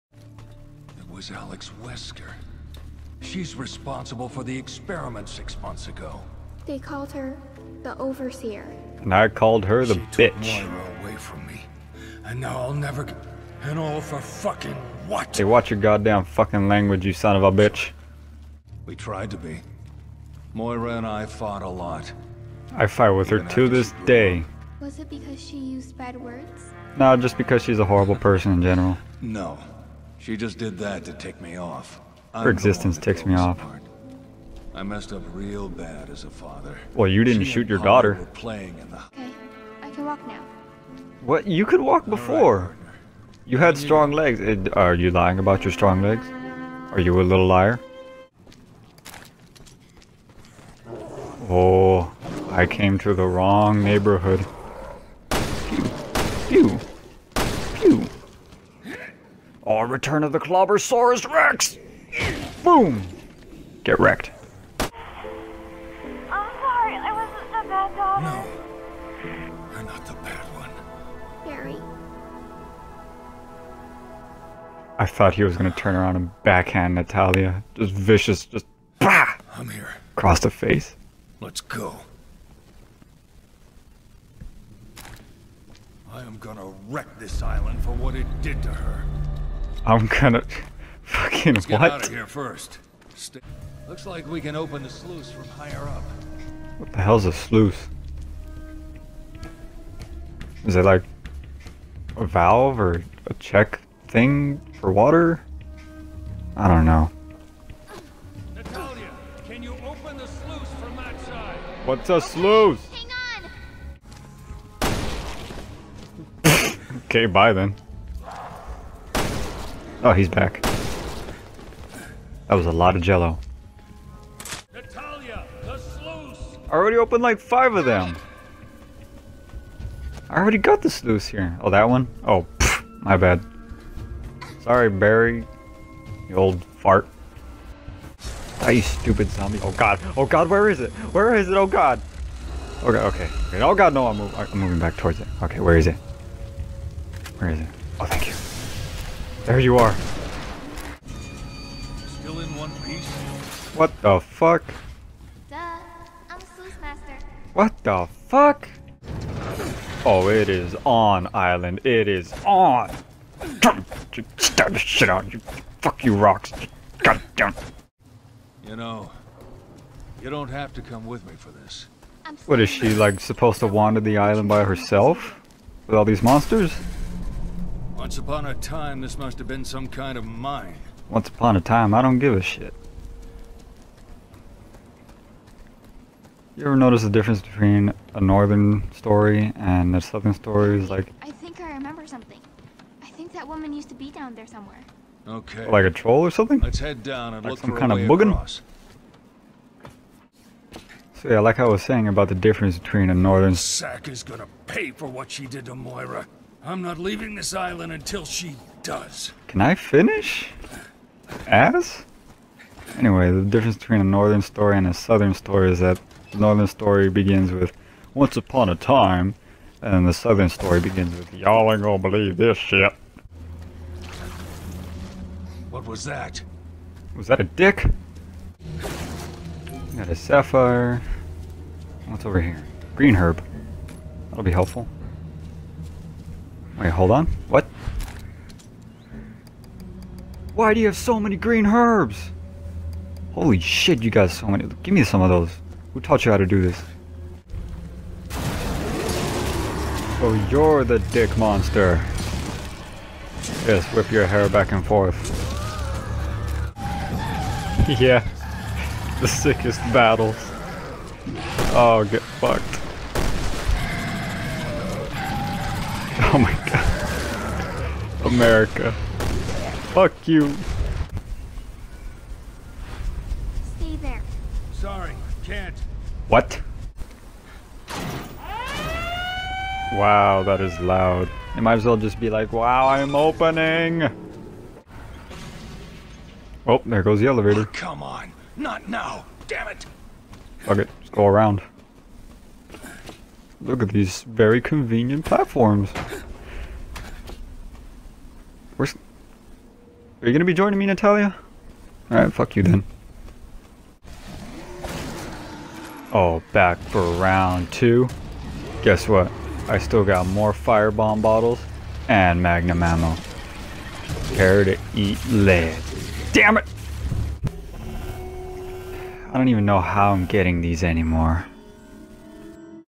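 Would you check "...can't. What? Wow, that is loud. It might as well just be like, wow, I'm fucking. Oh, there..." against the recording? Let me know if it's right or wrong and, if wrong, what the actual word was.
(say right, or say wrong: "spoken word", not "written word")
wrong: "opening", not "fucking".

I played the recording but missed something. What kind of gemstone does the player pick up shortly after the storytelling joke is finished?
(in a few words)
Sapphire.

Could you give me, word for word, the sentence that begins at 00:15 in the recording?
Hey, watch your goddamn fucking language, you son of a bitch.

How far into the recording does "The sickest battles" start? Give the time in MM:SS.
04:19.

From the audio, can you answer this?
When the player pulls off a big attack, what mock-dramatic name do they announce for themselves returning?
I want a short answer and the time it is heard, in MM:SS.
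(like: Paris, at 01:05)
Clobbersaurus Rex, at 01:00.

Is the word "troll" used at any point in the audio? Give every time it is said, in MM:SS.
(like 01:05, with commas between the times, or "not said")
03:15.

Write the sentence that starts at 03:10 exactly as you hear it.
Is like I think I remember something.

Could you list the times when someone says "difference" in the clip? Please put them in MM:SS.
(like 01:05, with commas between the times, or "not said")
03:07, 03:22, 03:33.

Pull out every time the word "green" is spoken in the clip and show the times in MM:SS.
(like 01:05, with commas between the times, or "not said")
03:52, 04:01.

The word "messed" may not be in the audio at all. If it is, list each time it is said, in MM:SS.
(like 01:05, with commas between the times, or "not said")
00:34.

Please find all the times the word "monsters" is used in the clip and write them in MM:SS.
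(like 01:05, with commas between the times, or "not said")
02:56, 04:11.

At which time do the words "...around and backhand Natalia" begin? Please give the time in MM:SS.
01:15.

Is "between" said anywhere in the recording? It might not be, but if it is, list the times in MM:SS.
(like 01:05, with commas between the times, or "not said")
03:07, 03:22, 03:33.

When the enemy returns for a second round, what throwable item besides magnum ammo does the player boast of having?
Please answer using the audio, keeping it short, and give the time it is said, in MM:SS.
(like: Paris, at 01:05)
Firebomb bottles, at 05:10.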